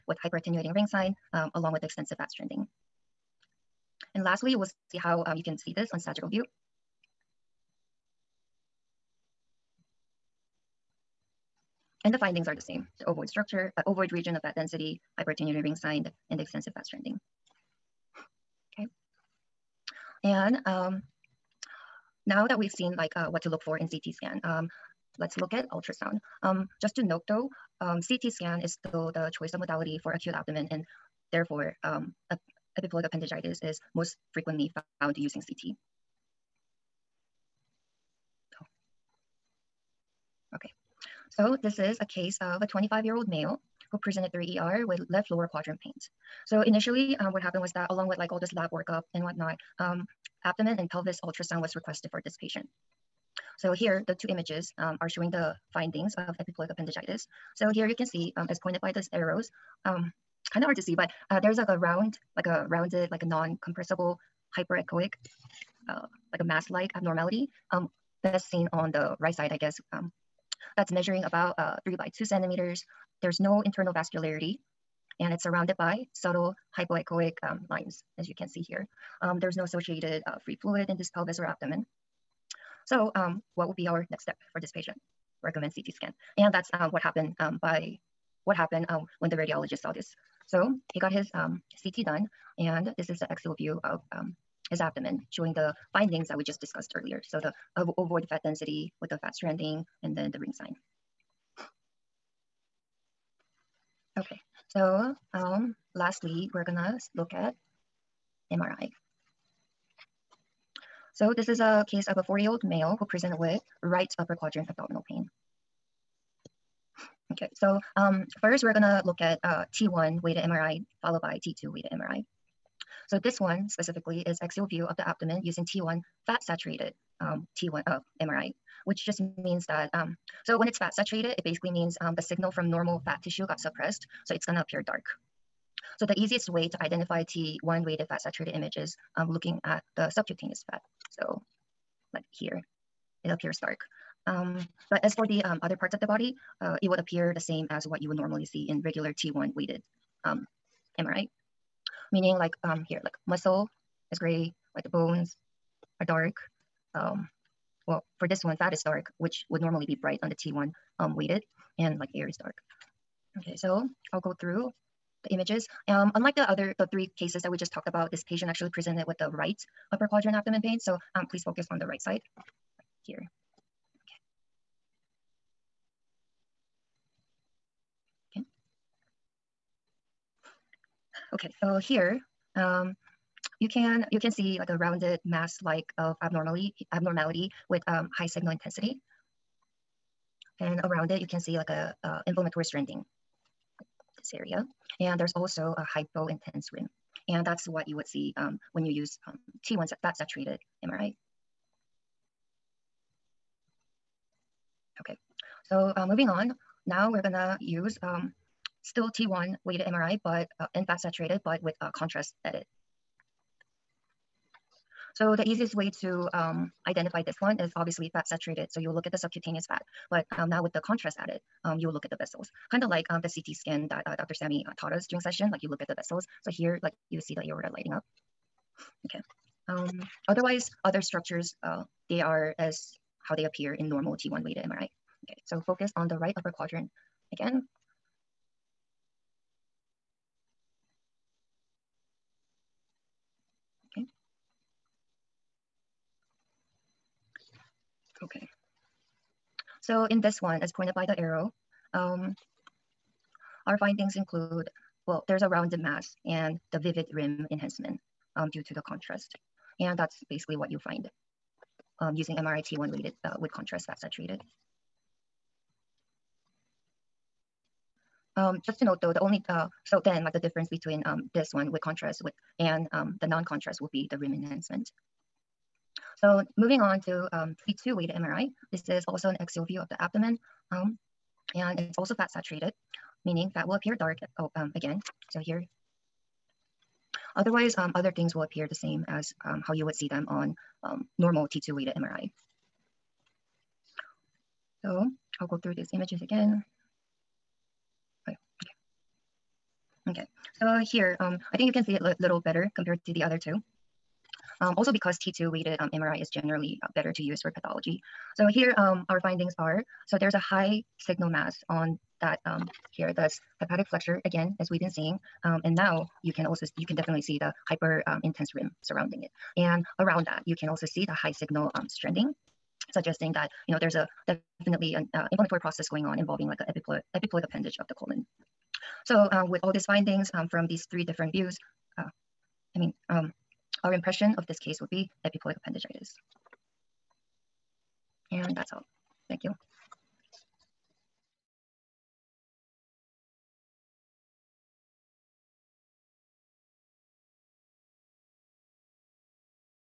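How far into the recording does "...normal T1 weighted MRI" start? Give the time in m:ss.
3:53.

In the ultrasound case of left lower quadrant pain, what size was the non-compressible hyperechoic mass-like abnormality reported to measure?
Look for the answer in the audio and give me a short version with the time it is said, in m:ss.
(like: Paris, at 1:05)
3 by 2 centimeters, at 1:11.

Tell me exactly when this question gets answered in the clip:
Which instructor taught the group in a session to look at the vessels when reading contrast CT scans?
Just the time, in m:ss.
3:44.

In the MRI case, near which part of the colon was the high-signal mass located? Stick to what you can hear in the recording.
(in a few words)
hepatic flexure.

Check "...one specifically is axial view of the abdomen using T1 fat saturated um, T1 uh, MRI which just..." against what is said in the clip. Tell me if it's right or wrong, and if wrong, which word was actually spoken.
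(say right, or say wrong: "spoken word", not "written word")
right.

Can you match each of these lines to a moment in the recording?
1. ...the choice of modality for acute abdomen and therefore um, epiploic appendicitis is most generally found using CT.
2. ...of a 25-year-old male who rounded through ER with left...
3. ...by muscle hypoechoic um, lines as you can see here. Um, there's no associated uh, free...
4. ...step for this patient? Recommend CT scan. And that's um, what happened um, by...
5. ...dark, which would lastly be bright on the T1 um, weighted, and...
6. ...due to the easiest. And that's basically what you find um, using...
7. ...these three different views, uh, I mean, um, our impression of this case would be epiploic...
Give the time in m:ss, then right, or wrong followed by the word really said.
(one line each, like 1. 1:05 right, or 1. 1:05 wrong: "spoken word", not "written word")
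1. 0:29 wrong: "frequently", not "generally"
2. 0:42 wrong: "presented", not "rounded"
3. 1:15 wrong: "subtle", not "muscle"
4. 1:24 right
5. 2:38 wrong: "normally", not "lastly"
6. 4:18 wrong: "contrast", not "easiest"
7. 5:30 right.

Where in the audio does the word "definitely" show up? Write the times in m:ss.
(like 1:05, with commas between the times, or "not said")
5:16, 5:24.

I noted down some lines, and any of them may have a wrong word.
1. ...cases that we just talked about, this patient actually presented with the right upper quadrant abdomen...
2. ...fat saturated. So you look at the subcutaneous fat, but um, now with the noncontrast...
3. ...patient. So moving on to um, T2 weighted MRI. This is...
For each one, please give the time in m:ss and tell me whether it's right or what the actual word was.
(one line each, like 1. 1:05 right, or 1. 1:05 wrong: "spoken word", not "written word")
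1. 2:47 right
2. 3:38 wrong: "contrast", not "noncontrast"
3. 4:34 wrong: "enhancement", not "patient".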